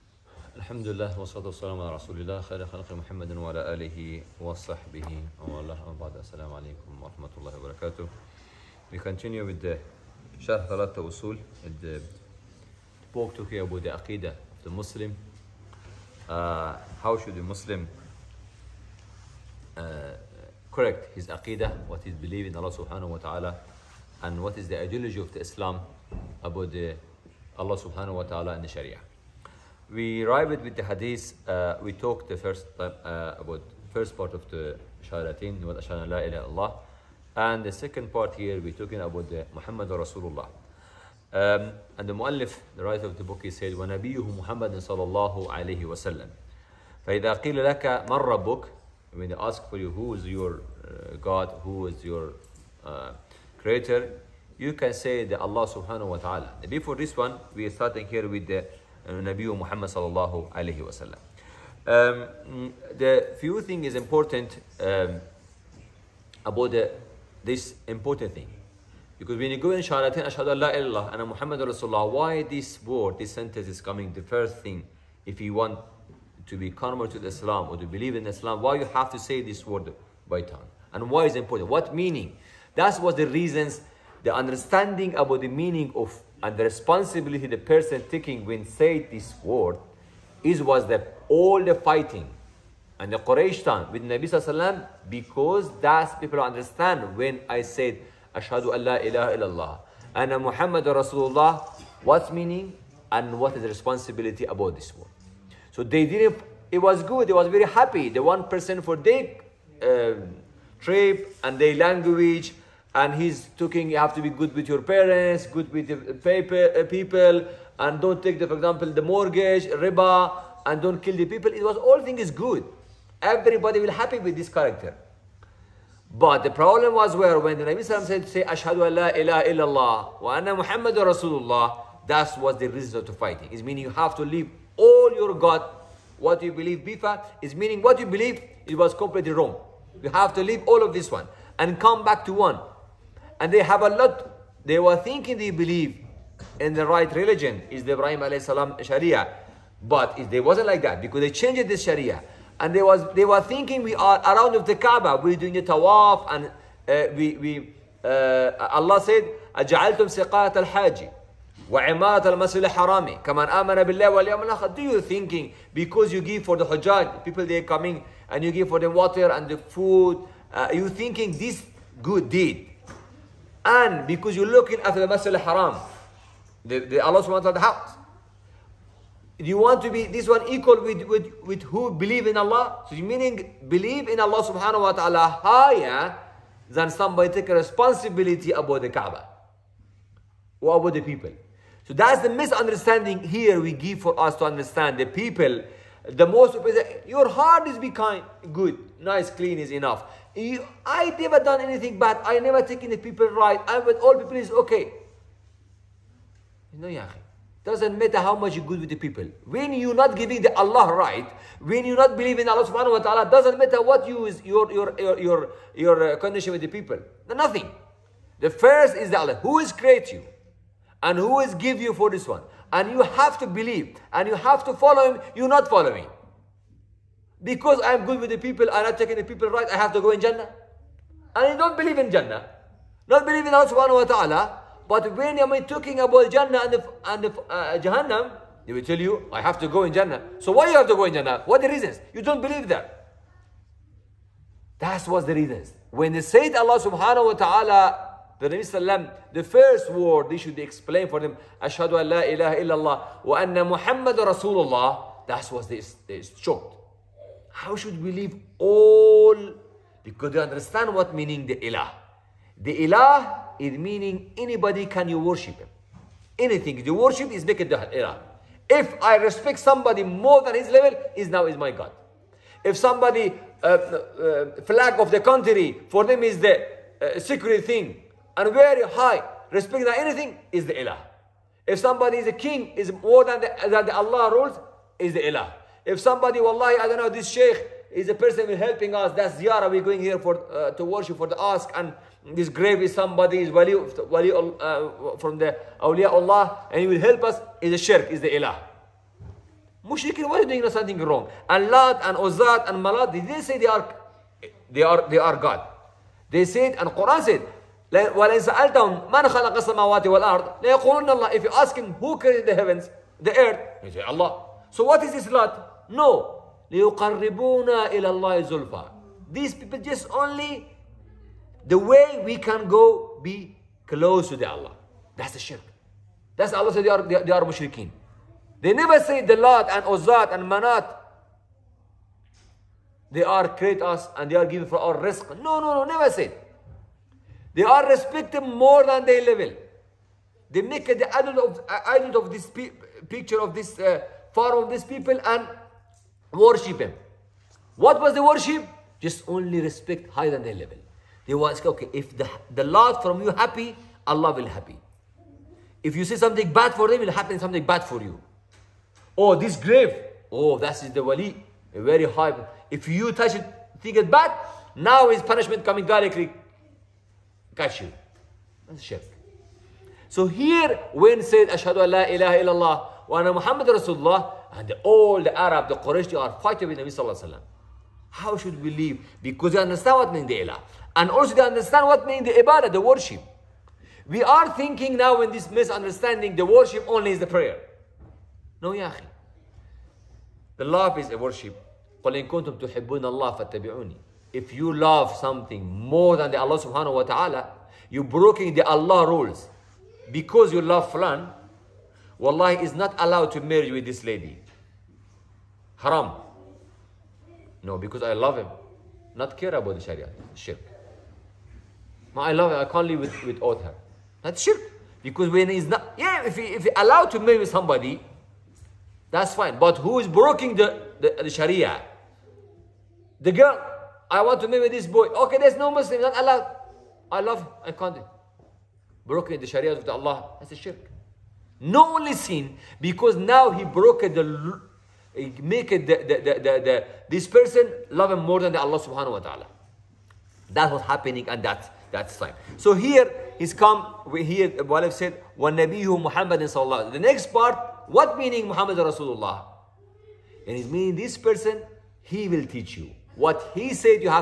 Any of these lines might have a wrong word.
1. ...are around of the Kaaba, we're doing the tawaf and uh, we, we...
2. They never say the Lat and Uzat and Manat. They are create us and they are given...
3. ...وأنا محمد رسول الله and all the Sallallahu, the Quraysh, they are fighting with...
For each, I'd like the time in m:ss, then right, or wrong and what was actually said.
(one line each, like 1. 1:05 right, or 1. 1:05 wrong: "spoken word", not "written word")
1. 2:33 right
2. 5:28 right
3. 6:13 wrong: "Arab", not "Sallallahu".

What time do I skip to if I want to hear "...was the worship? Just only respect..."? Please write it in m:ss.
5:47.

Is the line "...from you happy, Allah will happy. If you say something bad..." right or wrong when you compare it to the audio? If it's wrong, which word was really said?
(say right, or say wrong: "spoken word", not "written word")
right.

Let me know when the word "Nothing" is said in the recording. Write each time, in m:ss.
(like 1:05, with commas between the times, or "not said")
3:37.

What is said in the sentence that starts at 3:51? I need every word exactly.
And you don't believe in Jannah.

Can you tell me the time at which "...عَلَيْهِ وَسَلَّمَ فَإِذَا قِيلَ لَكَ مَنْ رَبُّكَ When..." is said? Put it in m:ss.
0:45.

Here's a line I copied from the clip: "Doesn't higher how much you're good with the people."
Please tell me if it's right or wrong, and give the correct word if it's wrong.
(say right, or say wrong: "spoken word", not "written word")
wrong: "matter", not "higher".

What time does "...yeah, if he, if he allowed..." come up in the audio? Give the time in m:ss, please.
6:55.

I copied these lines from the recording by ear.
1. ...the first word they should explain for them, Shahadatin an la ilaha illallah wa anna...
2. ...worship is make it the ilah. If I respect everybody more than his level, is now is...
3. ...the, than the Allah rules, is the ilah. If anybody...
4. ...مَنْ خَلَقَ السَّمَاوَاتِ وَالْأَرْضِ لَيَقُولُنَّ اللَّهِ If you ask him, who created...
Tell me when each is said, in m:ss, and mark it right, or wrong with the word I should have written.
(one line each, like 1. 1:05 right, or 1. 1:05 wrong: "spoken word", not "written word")
1. 4:09 wrong: "Ashhadu", not "Shahadatin"
2. 4:26 wrong: "somebody", not "everybody"
3. 4:43 wrong: "somebody", not "anybody"
4. 5:09 right.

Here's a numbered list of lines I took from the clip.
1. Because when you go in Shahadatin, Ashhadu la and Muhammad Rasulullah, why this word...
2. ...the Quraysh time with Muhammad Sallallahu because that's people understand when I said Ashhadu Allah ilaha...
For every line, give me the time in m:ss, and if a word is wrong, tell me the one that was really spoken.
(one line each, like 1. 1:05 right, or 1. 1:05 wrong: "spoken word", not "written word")
1. 1:09 right
2. 1:33 wrong: "Nabi", not "Muhammad".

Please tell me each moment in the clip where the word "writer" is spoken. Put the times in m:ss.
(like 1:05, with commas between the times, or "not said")
0:42.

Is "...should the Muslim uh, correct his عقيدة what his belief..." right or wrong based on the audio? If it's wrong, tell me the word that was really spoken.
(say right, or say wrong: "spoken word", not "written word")
right.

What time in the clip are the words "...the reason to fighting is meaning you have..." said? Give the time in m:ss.
2:12.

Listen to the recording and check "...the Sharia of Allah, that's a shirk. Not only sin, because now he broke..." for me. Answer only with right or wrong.
right.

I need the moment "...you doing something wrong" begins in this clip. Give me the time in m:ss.
5:00.